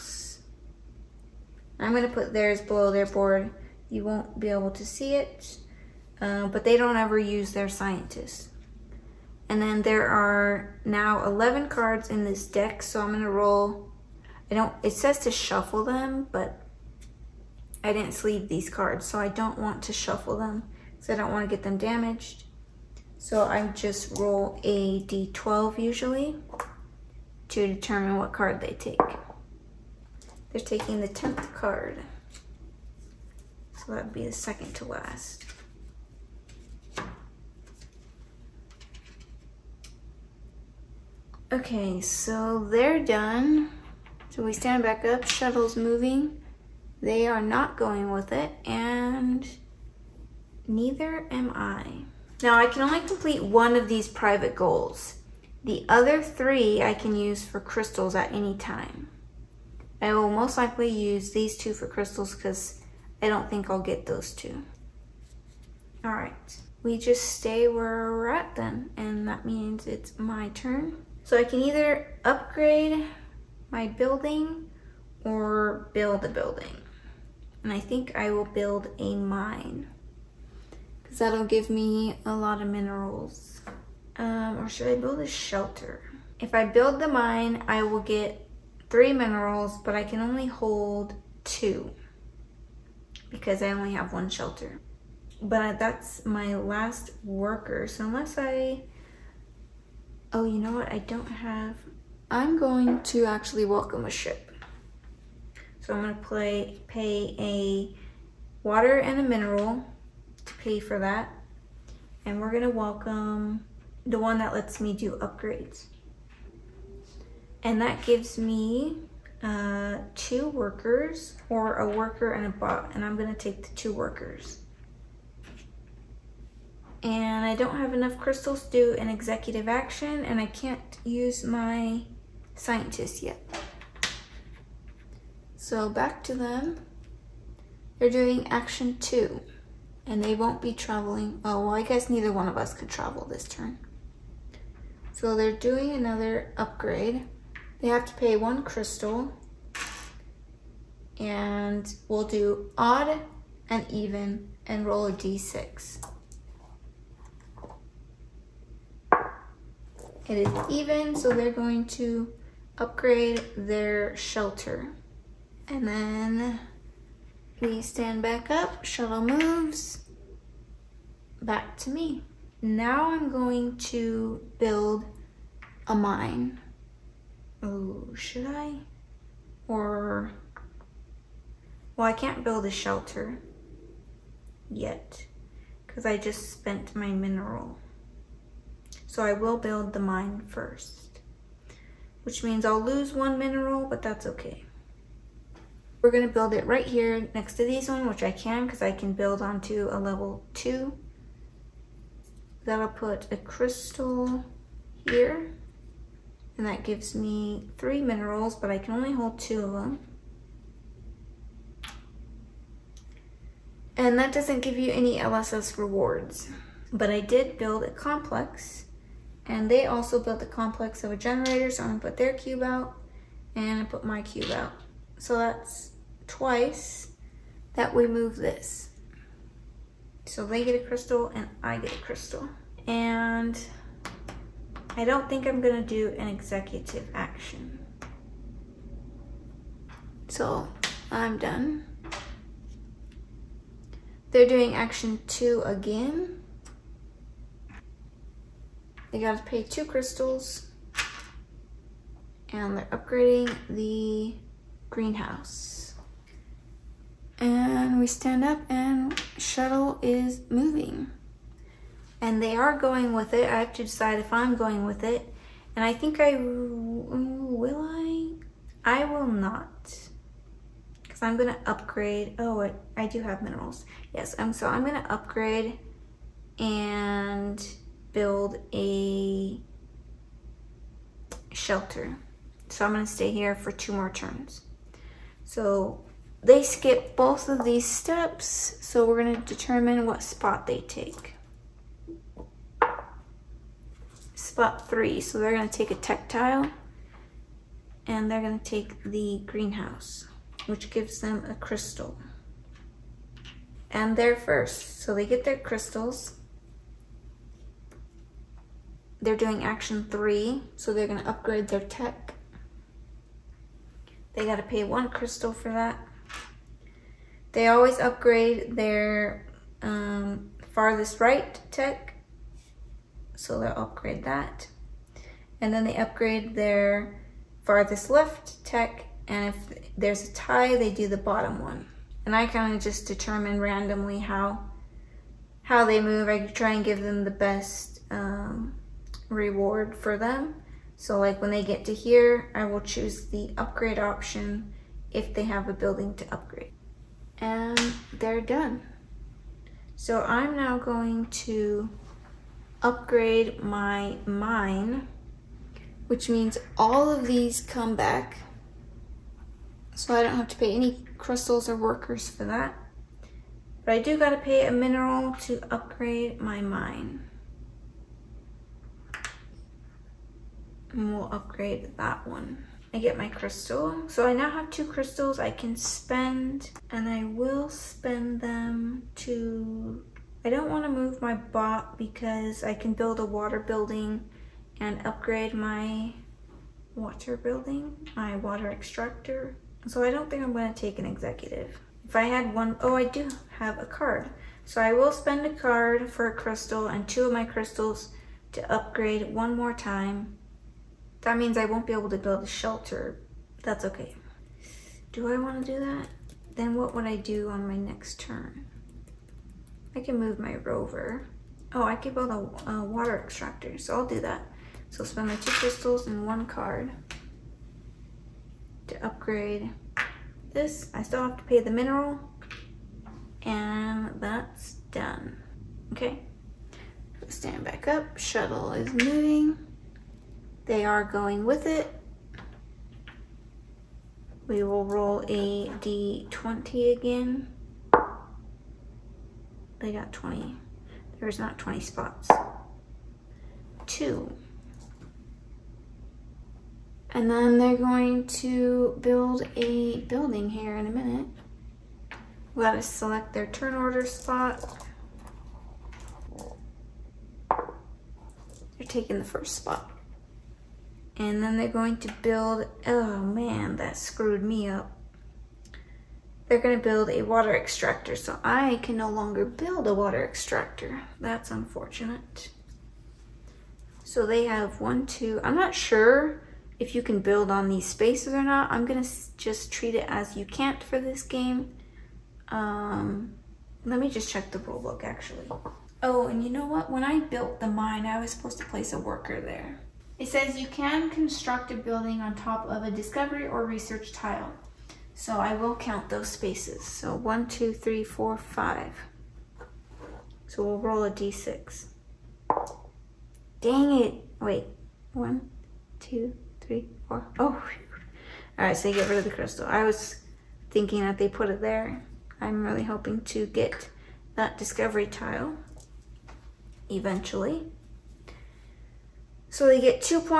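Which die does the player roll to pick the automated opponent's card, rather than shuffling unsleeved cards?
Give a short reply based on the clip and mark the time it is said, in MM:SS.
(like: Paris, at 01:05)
d12, at 00:25.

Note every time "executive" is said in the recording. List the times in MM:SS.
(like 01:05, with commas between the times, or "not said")
02:09, 03:56, 06:31.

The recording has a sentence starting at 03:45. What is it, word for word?
So that's twice that we move this.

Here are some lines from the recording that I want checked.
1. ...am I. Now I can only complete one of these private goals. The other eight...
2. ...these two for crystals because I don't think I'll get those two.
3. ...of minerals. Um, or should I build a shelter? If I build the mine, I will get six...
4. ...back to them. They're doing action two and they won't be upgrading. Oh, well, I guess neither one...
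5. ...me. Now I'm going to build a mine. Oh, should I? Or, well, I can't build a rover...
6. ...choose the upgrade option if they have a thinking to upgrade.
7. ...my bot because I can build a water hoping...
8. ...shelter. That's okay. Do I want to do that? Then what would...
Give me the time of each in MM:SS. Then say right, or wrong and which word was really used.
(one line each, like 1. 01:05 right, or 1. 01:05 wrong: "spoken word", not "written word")
1. 00:51 wrong: "three", not "eight"
2. 01:01 right
3. 01:22 wrong: "three", not "six"
4. 02:15 wrong: "traveling", not "upgrading"
5. 02:51 wrong: "shelter", not "rover"
6. 05:42 wrong: "building", not "thinking"
7. 06:21 wrong: "building", not "hoping"
8. 06:42 right.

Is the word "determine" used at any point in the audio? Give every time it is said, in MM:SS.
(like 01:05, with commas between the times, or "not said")
00:27, 04:49, 05:33.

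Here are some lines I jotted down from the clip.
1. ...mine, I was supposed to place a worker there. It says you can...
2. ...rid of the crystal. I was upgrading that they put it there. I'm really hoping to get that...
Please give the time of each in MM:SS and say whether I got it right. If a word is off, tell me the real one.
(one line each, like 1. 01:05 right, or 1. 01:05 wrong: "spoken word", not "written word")
1. 08:07 right
2. 08:29 wrong: "thinking", not "upgrading".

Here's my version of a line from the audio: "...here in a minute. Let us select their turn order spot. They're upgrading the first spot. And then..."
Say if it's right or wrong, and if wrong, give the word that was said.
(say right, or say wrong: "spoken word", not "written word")
wrong: "taking", not "upgrading".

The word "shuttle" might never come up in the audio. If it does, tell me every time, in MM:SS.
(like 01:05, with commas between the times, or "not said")
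00:45, 02:48, 04:19, 07:08.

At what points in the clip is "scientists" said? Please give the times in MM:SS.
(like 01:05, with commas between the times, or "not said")
00:07, 02:12.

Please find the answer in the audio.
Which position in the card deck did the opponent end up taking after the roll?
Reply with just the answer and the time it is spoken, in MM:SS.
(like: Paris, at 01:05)
10th card, at 00:31.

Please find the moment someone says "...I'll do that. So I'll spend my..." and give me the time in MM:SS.
06:53.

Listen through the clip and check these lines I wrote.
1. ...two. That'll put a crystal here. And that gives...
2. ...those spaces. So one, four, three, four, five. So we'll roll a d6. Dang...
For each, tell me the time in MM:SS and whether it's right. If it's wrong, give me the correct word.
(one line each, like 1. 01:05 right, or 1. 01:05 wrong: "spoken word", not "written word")
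1. 03:20 right
2. 08:16 wrong: "two", not "four".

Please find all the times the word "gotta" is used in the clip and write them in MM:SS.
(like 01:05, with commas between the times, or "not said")
04:09, 06:04.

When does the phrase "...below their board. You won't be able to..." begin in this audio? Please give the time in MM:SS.
00:02.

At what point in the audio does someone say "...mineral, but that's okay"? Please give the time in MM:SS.
03:13.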